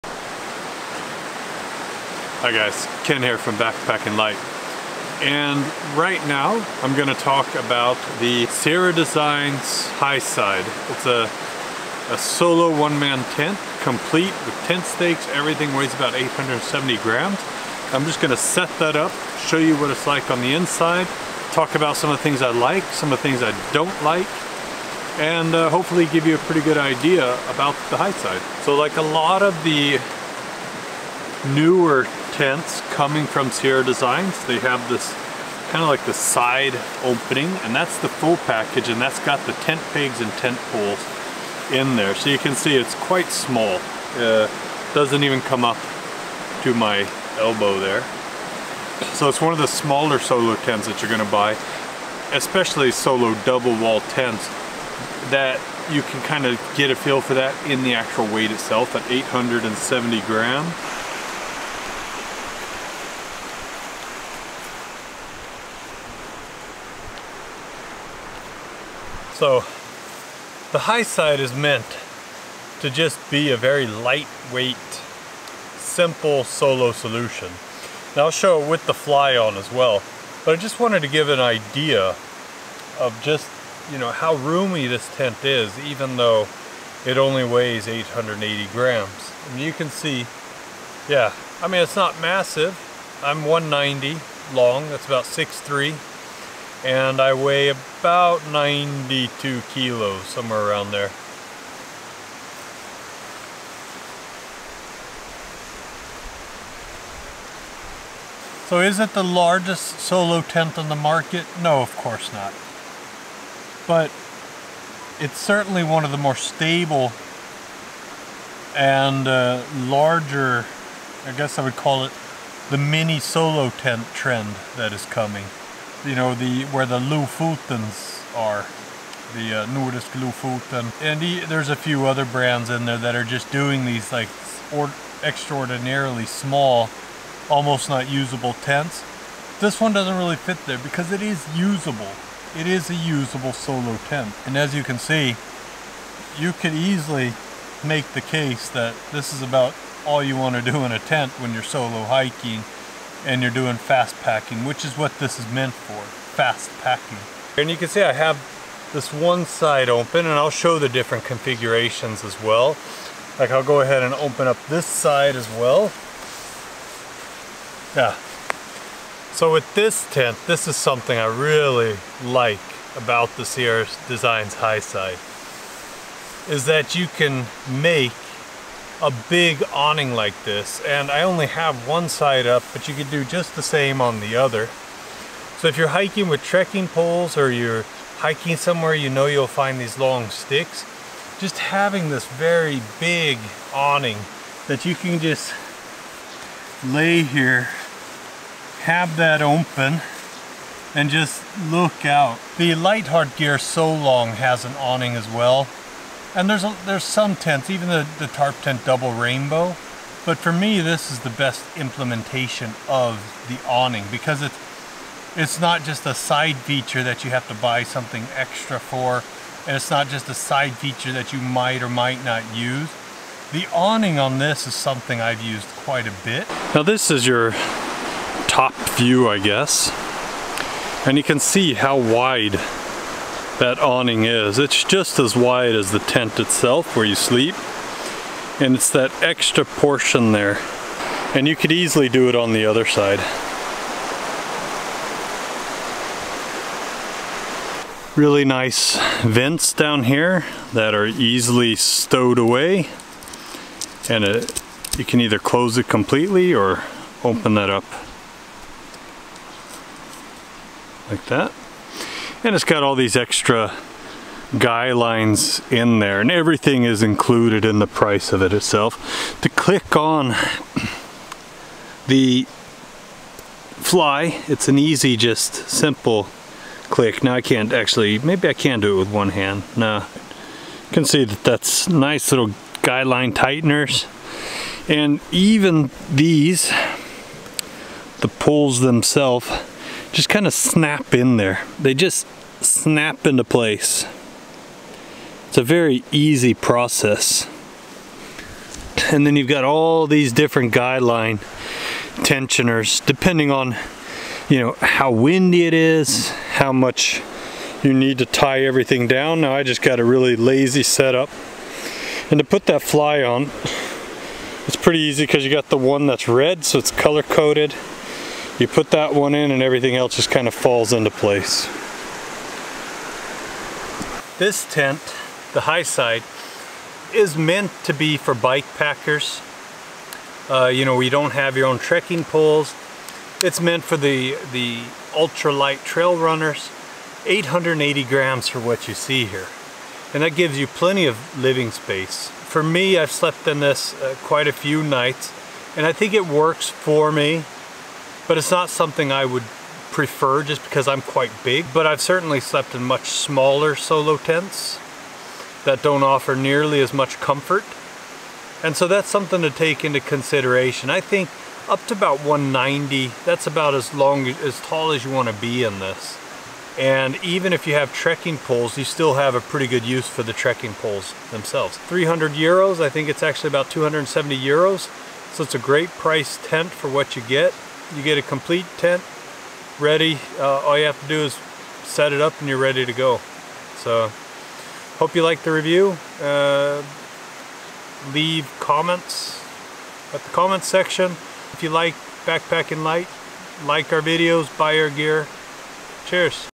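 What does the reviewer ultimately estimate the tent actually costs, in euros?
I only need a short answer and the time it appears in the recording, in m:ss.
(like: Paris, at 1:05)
270 euros, at 6:13.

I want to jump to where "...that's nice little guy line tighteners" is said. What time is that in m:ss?
4:41.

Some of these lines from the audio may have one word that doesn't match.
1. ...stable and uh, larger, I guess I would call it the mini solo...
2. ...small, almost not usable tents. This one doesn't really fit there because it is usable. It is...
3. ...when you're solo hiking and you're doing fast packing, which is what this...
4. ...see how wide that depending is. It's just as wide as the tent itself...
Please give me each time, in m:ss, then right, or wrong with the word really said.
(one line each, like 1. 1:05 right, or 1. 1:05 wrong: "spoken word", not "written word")
1. 1:56 right
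2. 2:16 right
3. 2:31 right
4. 3:51 wrong: "awning", not "depending".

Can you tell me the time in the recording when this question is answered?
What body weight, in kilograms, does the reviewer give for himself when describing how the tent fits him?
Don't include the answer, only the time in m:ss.
1:38.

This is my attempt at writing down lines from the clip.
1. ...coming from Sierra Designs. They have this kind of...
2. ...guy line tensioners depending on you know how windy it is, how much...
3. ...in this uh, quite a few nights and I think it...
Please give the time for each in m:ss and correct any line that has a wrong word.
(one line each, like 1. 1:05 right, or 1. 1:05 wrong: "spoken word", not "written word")
1. 0:32 right
2. 5:00 right
3. 5:43 right.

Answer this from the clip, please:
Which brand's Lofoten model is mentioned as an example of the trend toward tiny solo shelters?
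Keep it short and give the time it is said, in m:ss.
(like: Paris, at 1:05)
Nordisk, at 2:09.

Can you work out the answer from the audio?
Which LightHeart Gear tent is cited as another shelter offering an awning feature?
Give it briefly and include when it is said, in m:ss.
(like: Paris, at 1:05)
SoLong, at 3:23.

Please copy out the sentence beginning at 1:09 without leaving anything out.
So the high side is meant to just be a very lightweight, simple solo solution.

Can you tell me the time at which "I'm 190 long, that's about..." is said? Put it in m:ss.
1:33.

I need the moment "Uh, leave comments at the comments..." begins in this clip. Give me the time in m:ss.
6:26.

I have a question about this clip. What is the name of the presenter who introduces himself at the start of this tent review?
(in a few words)
Ken.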